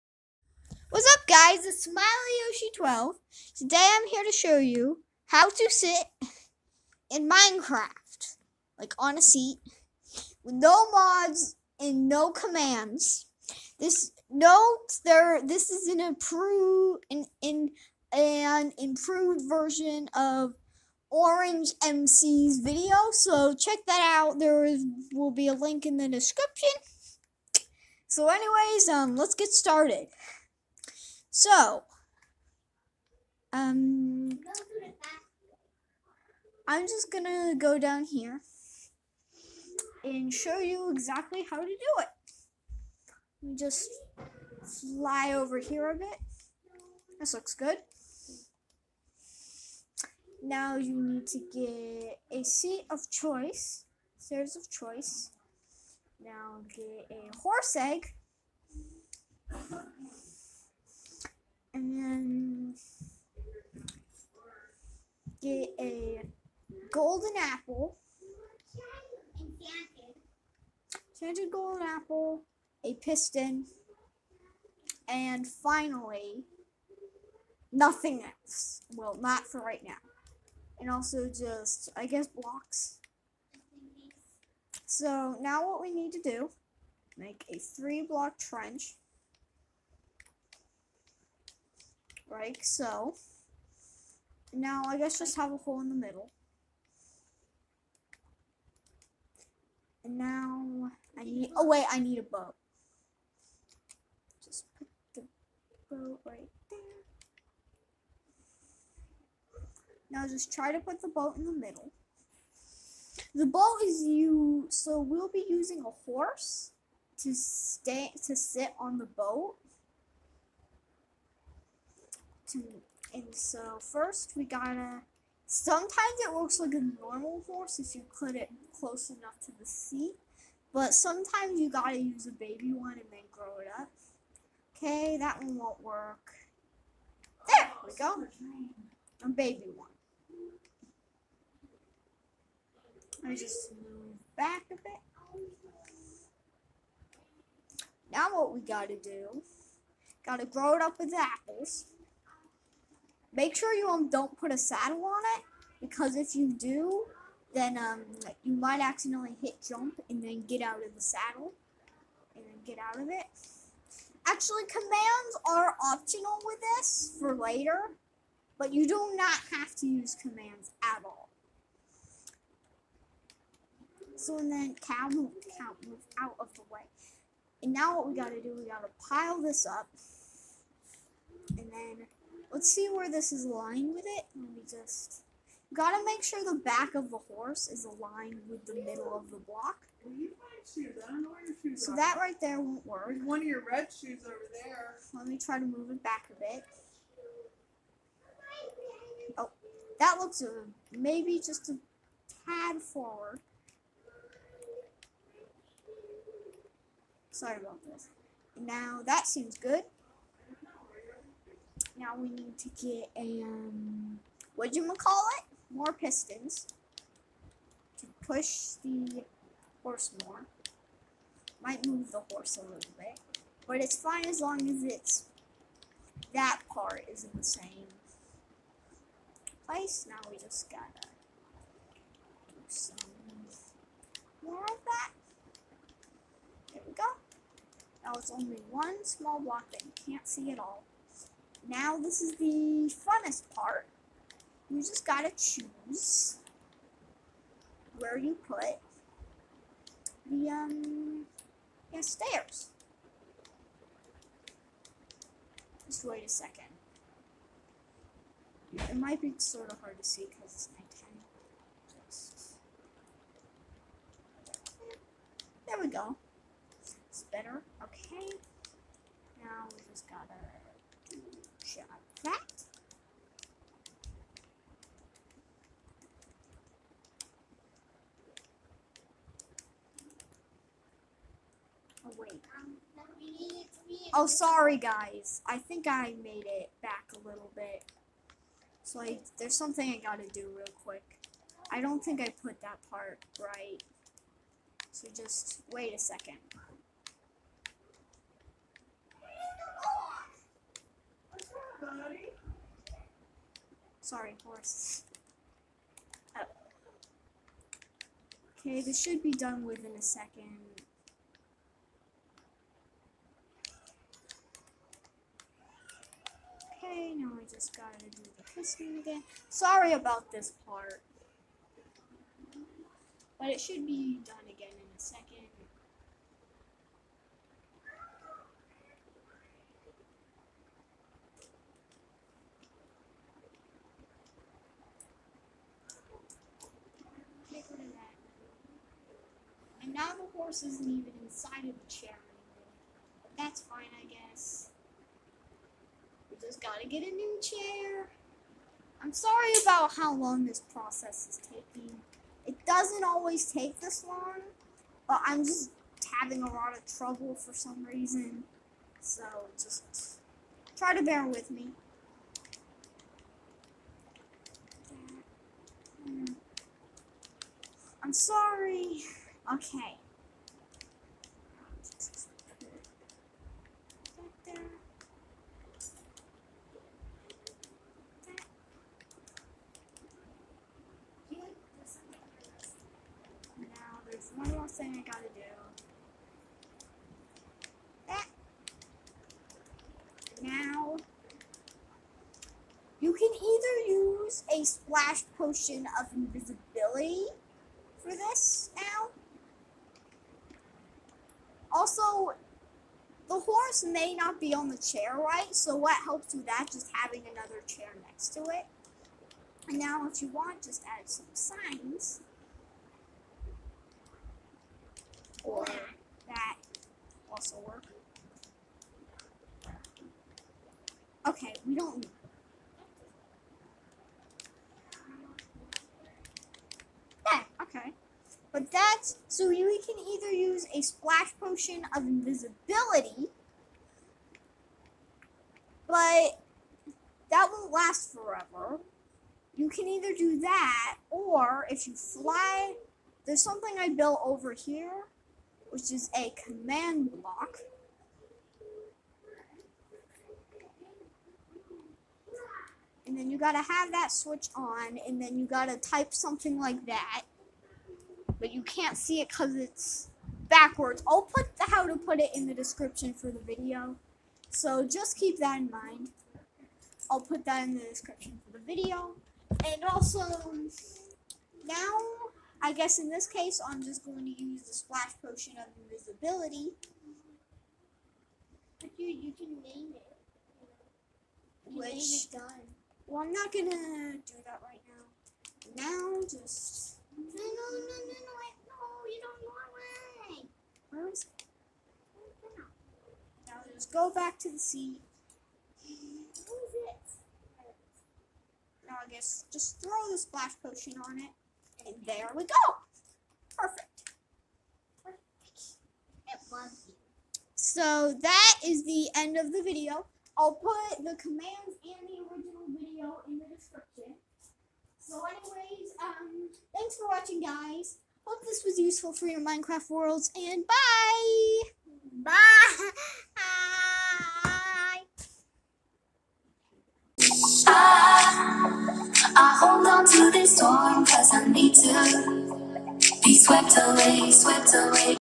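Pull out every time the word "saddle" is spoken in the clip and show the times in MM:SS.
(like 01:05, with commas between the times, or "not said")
02:34, 02:41.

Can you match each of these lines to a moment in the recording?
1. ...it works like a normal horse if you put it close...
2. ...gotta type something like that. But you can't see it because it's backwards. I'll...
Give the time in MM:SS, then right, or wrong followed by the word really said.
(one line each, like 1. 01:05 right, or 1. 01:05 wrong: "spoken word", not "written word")
1. 02:06 right
2. 07:35 right.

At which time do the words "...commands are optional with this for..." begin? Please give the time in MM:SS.
02:44.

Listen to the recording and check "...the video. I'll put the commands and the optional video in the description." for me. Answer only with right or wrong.
wrong.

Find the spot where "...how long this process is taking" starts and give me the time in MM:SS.
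05:49.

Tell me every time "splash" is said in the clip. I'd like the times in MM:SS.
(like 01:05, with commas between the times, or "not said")
06:34, 07:10, 07:54, 08:20.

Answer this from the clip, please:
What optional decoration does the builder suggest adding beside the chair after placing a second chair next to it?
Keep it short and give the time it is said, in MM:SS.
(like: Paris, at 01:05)
signs, at 06:50.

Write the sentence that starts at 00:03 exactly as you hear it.
Today I'm here to show you how to sit in Minecraft, like on a seat, with no mods and no commands.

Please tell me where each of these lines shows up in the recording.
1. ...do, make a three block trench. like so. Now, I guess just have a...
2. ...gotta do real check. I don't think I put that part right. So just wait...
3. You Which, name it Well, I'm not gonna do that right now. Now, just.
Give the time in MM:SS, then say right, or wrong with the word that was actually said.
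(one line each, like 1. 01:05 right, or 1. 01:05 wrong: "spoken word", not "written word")
1. 01:26 right
2. 04:49 wrong: "quick", not "check"
3. 08:01 right.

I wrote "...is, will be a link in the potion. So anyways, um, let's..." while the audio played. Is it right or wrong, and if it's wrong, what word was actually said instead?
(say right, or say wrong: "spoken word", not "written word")
wrong: "description", not "potion".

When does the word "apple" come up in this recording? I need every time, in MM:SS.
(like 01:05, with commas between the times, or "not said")
01:07, 01:11, 02:31.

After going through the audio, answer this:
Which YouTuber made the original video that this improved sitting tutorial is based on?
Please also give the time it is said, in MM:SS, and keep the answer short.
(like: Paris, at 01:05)
Orange MC, at 00:21.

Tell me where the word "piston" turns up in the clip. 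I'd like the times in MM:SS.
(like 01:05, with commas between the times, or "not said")
01:12, 03:35, 05:18.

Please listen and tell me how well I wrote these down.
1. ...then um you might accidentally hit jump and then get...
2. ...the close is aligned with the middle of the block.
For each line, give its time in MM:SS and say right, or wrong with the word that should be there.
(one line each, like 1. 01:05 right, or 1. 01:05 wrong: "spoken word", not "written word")
1. 02:37 right
2. 03:07 wrong: "horse", not "close".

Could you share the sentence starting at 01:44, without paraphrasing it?
Just put the boat right there.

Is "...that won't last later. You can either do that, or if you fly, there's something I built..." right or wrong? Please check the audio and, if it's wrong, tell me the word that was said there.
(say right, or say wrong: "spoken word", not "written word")
wrong: "forever", not "later".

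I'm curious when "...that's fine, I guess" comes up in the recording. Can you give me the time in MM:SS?
05:43.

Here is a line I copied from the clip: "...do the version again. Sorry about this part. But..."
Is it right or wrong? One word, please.
wrong.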